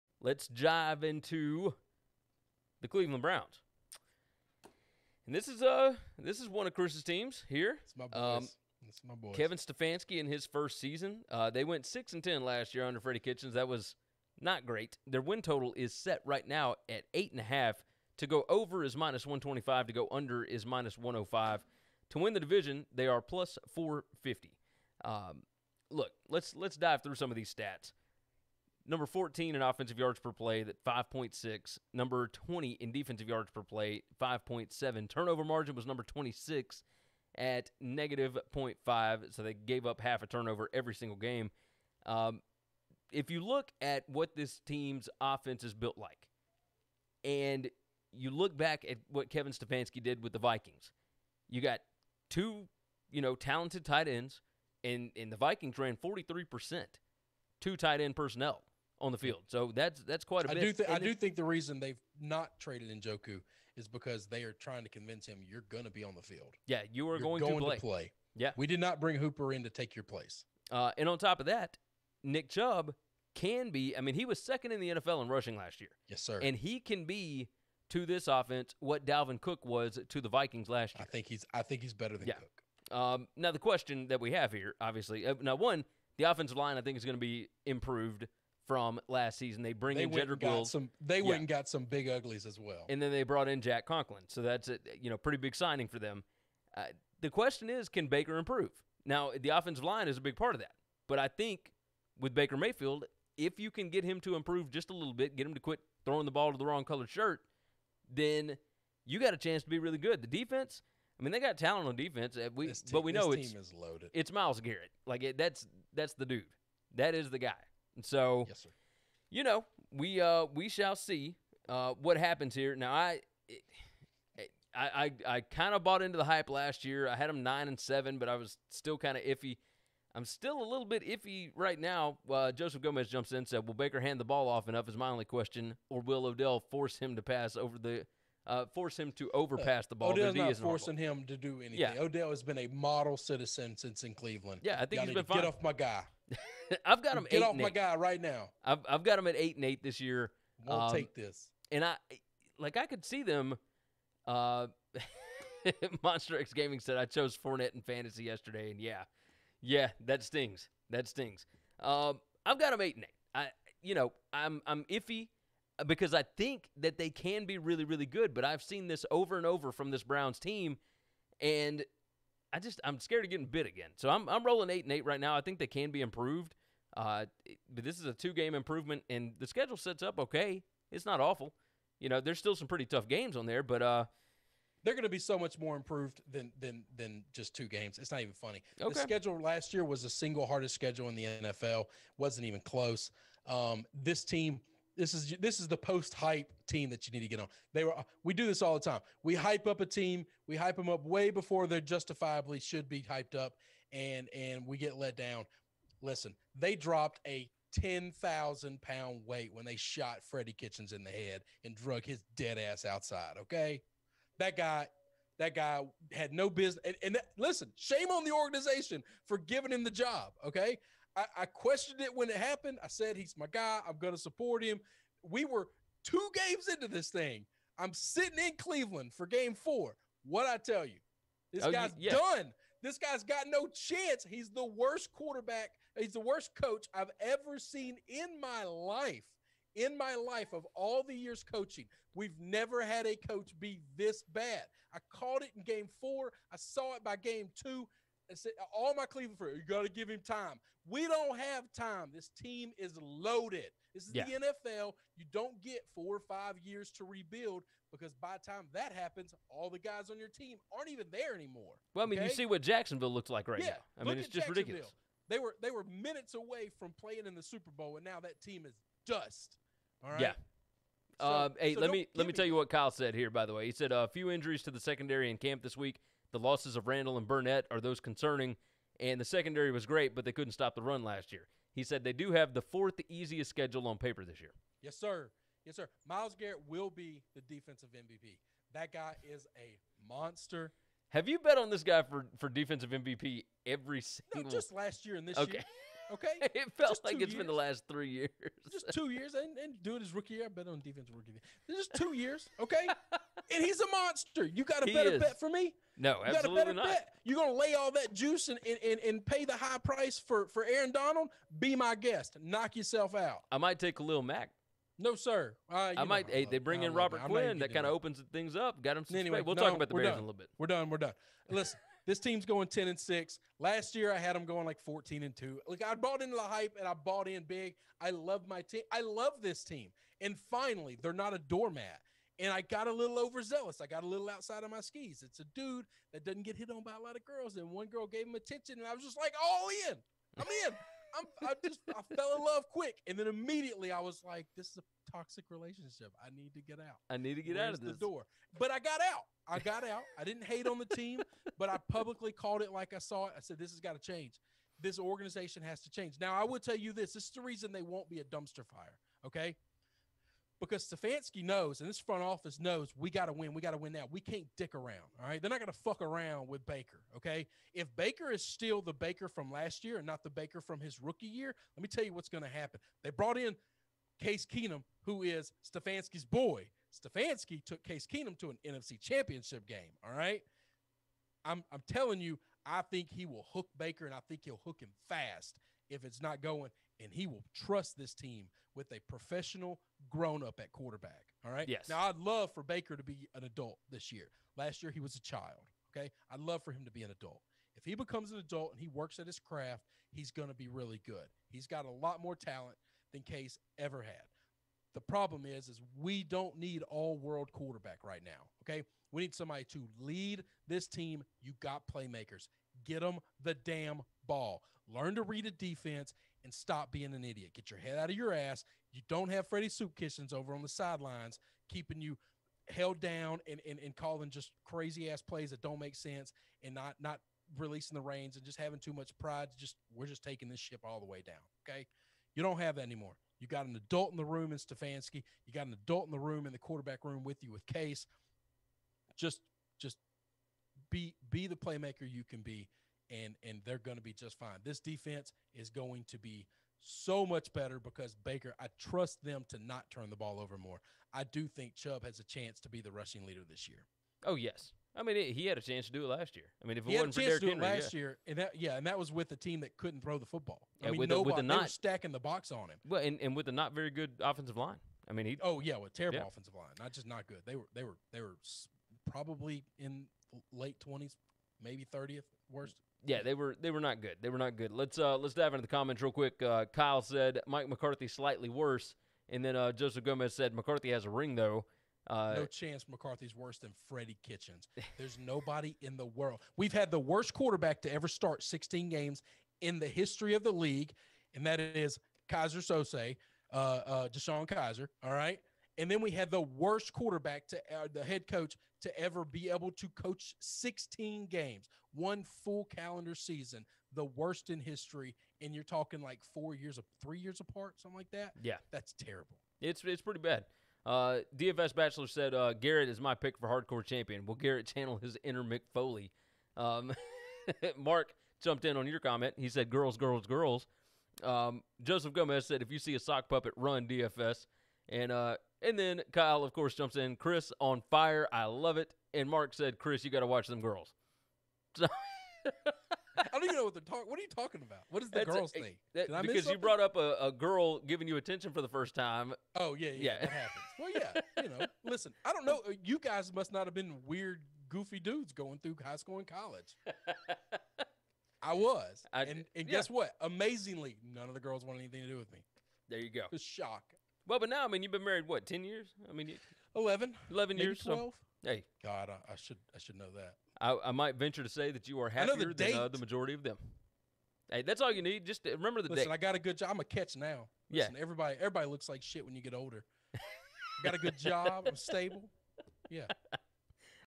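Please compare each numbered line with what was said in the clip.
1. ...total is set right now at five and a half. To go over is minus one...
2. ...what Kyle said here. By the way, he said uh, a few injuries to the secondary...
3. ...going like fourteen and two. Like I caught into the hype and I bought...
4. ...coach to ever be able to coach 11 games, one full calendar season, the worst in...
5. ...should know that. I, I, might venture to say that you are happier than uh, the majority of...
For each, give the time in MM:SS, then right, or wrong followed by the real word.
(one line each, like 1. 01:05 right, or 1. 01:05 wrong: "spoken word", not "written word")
1. 00:15 wrong: "eight", not "five"
2. 04:32 right
3. 05:24 wrong: "bought", not "caught"
4. 08:18 wrong: "16", not "11"
5. 09:19 right.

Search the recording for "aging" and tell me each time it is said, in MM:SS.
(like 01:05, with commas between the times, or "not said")
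not said.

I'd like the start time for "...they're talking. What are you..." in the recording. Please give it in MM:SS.
08:53.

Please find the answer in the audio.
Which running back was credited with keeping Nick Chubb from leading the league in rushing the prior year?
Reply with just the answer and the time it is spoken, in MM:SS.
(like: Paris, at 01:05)
Derrick Henry, at 07:37.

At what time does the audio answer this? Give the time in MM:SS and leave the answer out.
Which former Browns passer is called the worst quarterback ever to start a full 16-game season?
08:14.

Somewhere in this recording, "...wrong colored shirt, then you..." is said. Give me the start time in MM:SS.
01:46.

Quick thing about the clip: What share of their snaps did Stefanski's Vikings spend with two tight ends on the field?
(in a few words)
43%.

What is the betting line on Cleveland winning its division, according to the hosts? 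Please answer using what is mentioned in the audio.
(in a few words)
+450.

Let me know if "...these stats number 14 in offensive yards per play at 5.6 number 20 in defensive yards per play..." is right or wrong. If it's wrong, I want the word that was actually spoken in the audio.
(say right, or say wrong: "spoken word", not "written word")
right.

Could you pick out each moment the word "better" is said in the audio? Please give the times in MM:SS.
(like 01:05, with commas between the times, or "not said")
01:21, 05:04, 07:27.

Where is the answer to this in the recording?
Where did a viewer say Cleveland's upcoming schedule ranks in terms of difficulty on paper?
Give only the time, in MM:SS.
04:42.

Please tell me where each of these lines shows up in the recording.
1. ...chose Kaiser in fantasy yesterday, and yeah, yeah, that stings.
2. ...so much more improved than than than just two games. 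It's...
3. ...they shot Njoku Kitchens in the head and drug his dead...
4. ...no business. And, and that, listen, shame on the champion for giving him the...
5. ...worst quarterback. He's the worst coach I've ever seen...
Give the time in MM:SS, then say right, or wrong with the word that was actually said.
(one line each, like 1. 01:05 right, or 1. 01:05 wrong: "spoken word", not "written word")
1. 02:37 wrong: "Fournette", not "Kaiser"
2. 03:05 right
3. 03:29 wrong: "Freddie", not "Njoku"
4. 03:36 wrong: "organization", not "champion"
5. 03:54 right.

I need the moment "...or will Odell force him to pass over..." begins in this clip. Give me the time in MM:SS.
02:15.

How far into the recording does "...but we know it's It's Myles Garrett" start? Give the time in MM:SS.
01:52.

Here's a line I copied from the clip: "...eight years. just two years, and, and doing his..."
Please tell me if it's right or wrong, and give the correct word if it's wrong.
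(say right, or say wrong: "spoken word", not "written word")
wrong: "three", not "eight".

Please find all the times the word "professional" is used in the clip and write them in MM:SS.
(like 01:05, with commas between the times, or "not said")
06:29.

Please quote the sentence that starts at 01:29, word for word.
They bring they in Jedrick Wills.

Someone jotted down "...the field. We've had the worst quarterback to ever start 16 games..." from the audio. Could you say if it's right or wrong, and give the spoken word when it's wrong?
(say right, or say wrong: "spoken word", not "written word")
wrong: "world", not "field".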